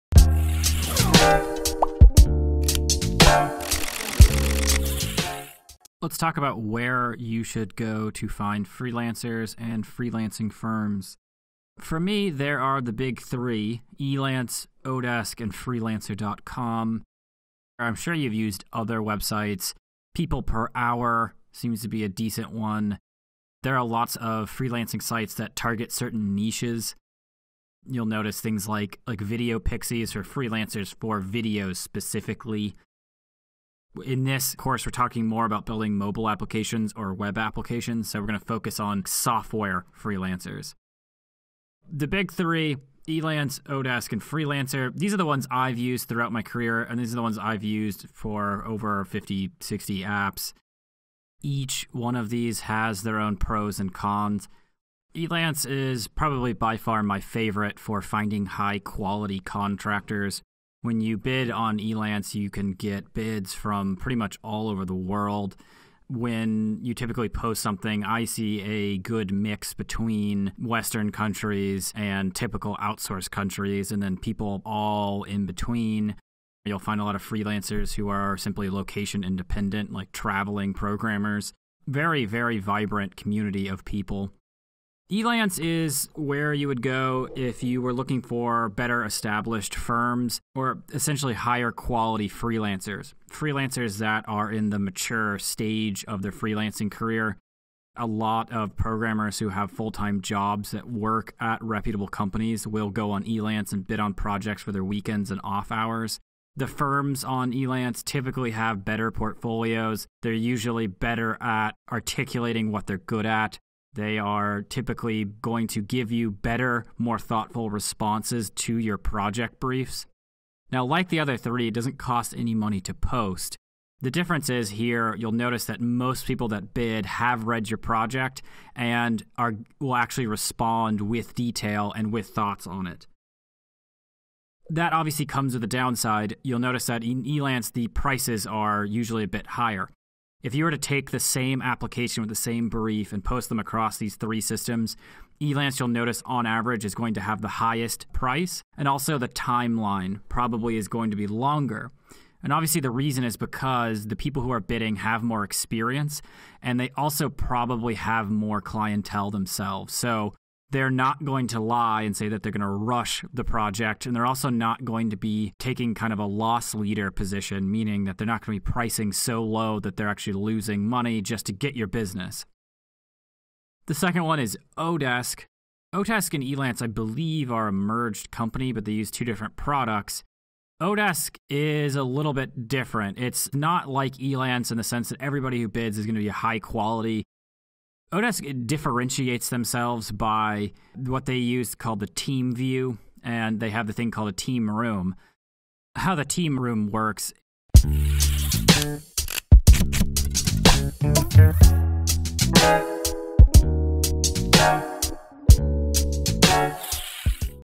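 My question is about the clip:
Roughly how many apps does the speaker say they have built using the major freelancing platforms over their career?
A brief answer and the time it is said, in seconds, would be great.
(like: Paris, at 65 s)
50, 60, at 49 s.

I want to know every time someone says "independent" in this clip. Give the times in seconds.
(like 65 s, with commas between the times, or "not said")
79 s.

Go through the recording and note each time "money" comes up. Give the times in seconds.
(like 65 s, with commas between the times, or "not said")
122 s, 170 s.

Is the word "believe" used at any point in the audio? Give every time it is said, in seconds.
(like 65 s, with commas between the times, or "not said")
176 s.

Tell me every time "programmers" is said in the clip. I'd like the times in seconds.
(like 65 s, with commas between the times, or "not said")
80 s, 98 s.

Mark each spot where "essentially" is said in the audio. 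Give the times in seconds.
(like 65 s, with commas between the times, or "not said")
90 s.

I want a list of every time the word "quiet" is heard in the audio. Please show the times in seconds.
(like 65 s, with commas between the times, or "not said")
not said.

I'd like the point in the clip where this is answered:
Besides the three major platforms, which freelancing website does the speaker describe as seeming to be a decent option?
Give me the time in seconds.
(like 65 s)
20 s.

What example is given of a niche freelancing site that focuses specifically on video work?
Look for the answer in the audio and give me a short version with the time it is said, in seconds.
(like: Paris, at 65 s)
Video Pixies, at 29 s.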